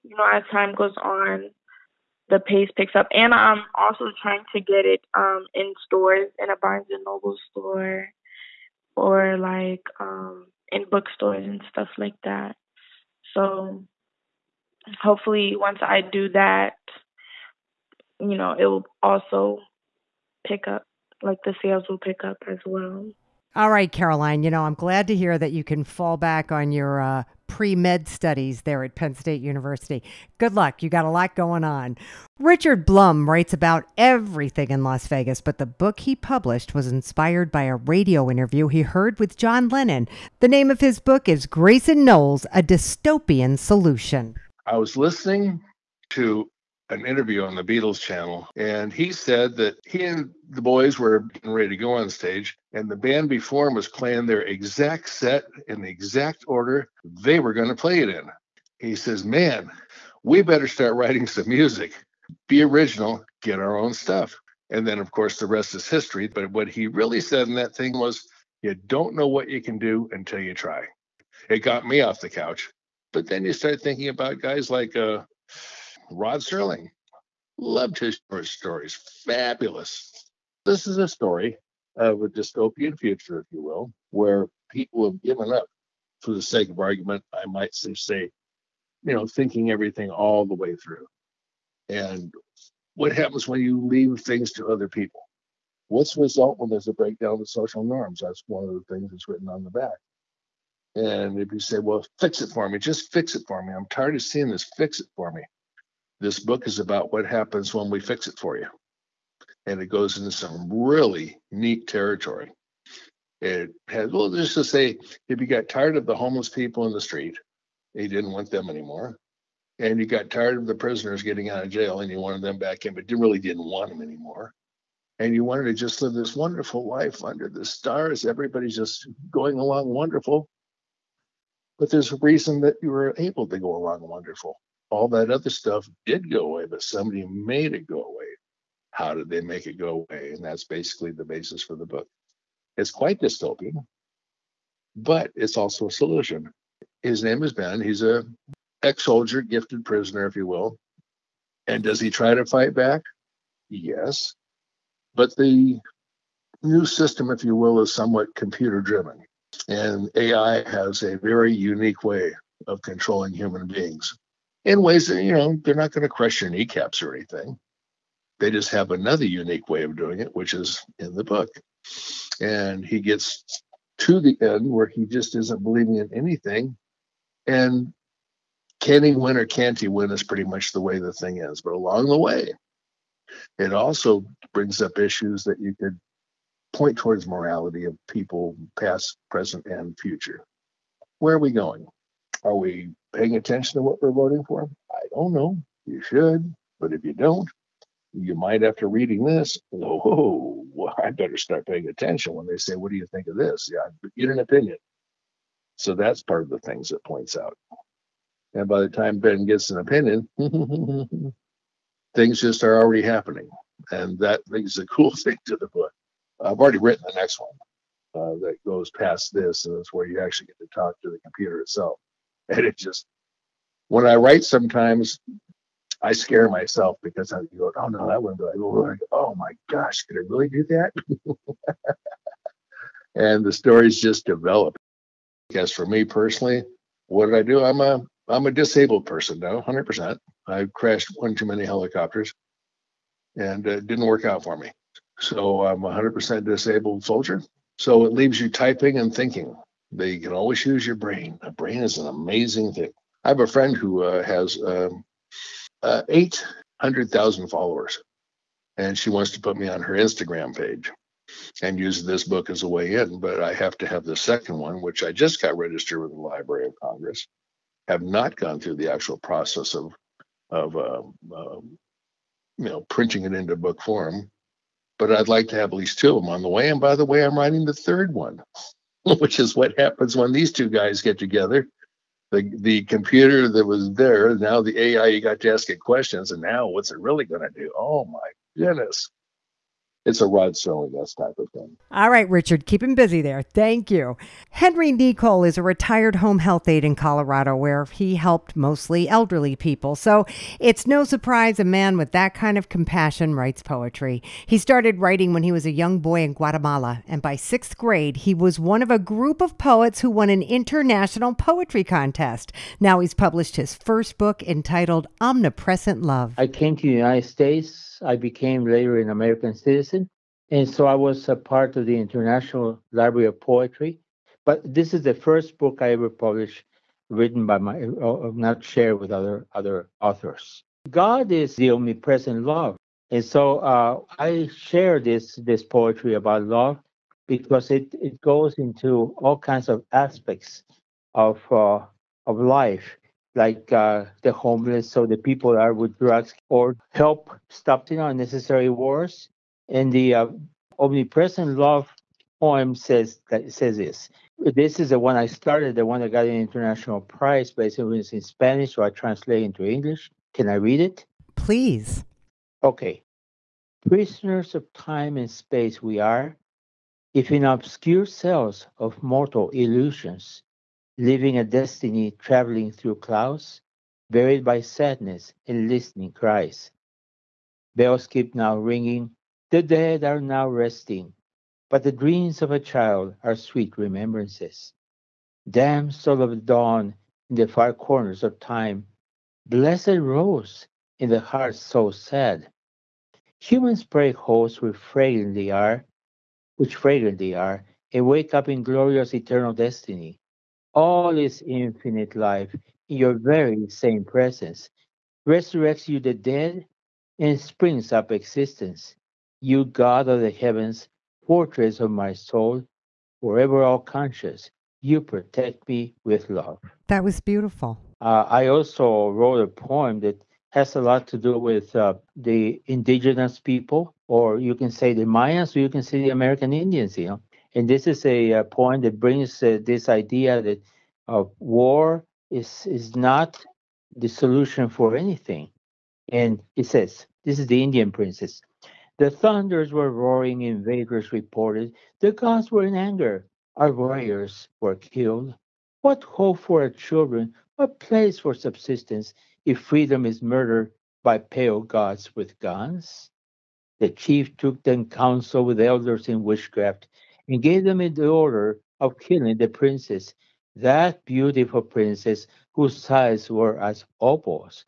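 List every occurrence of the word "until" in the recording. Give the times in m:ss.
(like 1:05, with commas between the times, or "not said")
1:10.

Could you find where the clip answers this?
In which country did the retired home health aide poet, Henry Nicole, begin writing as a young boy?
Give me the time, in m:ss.
5:06.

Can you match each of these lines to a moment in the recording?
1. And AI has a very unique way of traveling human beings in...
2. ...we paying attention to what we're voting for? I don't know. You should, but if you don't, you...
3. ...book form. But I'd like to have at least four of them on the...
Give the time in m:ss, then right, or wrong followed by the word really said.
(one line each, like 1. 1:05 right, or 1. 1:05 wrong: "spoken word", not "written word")
1. 2:39 wrong: "controlling", not "traveling"
2. 3:12 right
3. 4:33 wrong: "two", not "four".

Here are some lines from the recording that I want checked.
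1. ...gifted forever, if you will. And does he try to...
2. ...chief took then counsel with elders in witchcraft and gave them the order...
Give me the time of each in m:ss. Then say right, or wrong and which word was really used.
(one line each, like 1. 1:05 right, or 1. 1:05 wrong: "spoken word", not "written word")
1. 2:29 wrong: "prisoner", not "forever"
2. 7:33 right.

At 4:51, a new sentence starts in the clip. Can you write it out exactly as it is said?
All right, Richard, keep him busy there.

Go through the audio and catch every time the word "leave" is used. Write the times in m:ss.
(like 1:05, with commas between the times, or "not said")
1:33, 4:08.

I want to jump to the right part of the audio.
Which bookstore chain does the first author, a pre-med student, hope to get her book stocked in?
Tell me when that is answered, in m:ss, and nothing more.
0:06.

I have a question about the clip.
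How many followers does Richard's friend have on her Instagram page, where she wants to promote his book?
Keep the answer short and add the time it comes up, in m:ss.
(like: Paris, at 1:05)
800,000, at 4:16.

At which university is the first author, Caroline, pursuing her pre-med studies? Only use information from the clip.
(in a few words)
Penn State University.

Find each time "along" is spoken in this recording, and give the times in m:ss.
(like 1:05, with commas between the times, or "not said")
2:09, 2:13, 3:01.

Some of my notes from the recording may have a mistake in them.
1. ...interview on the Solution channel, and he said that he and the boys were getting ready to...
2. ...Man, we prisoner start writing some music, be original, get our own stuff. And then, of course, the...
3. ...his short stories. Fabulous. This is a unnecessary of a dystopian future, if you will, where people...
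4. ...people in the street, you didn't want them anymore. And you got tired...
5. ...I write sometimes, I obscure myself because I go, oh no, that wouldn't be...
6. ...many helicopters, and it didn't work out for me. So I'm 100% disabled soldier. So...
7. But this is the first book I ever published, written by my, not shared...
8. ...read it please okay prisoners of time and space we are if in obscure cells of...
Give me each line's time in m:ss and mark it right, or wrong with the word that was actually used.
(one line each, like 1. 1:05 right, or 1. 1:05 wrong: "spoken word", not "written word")
1. 0:47 wrong: "Beatles", not "Solution"
2. 0:59 wrong: "better", not "prisoner"
3. 1:17 wrong: "story", not "unnecessary"
4. 1:56 right
5. 3:44 wrong: "scare", not "obscure"
6. 4:01 right
7. 5:24 right
8. 6:00 right.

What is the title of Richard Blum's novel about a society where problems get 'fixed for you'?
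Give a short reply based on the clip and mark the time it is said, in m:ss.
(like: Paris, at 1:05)
Grayson Knowles A Dystopian Solution, at 0:41.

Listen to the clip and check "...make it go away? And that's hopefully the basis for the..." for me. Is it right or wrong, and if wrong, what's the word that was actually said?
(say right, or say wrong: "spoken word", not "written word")
wrong: "basically", not "hopefully".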